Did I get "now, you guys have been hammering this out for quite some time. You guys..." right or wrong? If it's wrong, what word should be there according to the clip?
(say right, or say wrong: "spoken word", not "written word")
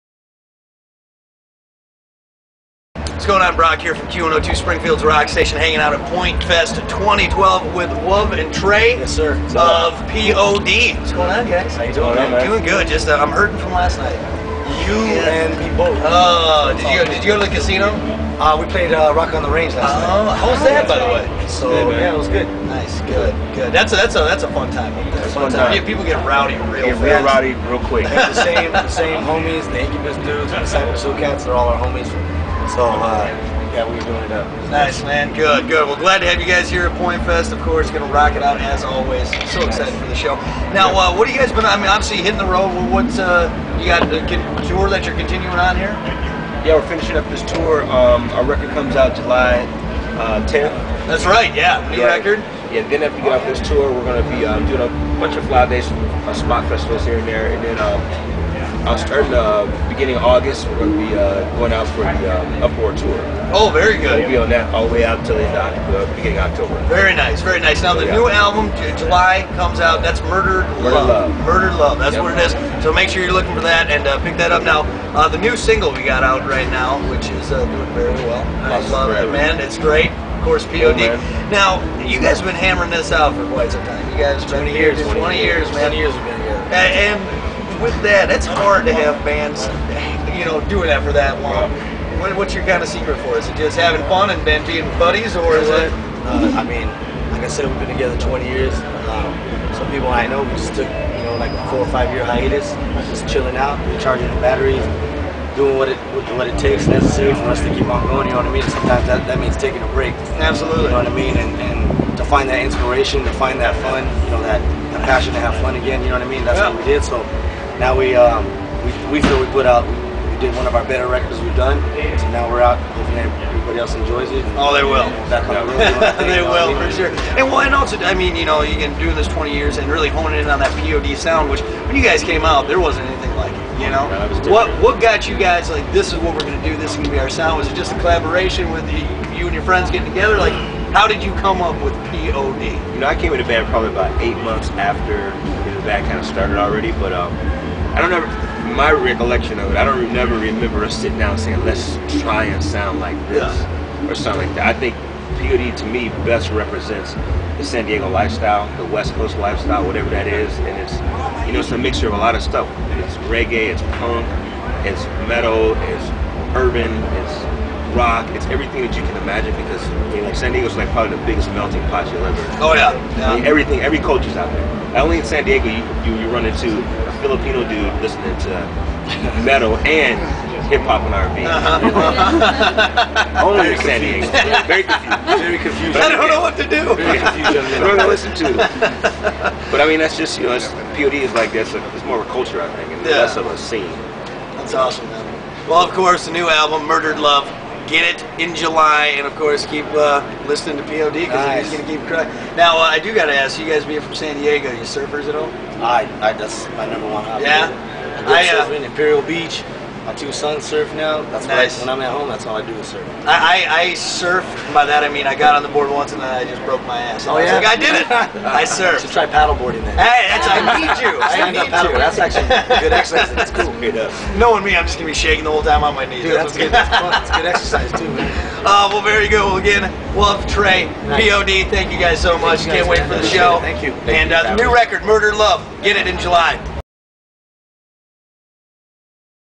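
right.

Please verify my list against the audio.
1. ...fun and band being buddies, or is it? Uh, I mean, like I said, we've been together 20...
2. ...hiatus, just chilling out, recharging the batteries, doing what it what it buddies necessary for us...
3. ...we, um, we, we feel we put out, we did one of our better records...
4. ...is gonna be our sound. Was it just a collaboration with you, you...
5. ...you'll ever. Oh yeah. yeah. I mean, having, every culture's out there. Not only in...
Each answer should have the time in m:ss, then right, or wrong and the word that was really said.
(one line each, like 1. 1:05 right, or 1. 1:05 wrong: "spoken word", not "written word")
1. 1:34 right
2. 1:42 wrong: "takes", not "buddies"
3. 1:57 right
4. 2:16 right
5. 2:52 wrong: "everything", not "having".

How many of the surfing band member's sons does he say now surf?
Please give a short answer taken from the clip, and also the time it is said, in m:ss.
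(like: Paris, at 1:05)
2, at 3:30.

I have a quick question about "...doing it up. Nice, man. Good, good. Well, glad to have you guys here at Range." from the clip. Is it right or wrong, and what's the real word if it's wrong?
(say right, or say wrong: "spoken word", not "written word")
wrong: "Pointfest", not "Range".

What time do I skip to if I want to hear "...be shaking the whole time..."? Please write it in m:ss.
3:45.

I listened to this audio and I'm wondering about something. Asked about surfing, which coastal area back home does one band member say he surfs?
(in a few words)
Imperial Beach.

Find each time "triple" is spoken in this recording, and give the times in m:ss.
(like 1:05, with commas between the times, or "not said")
not said.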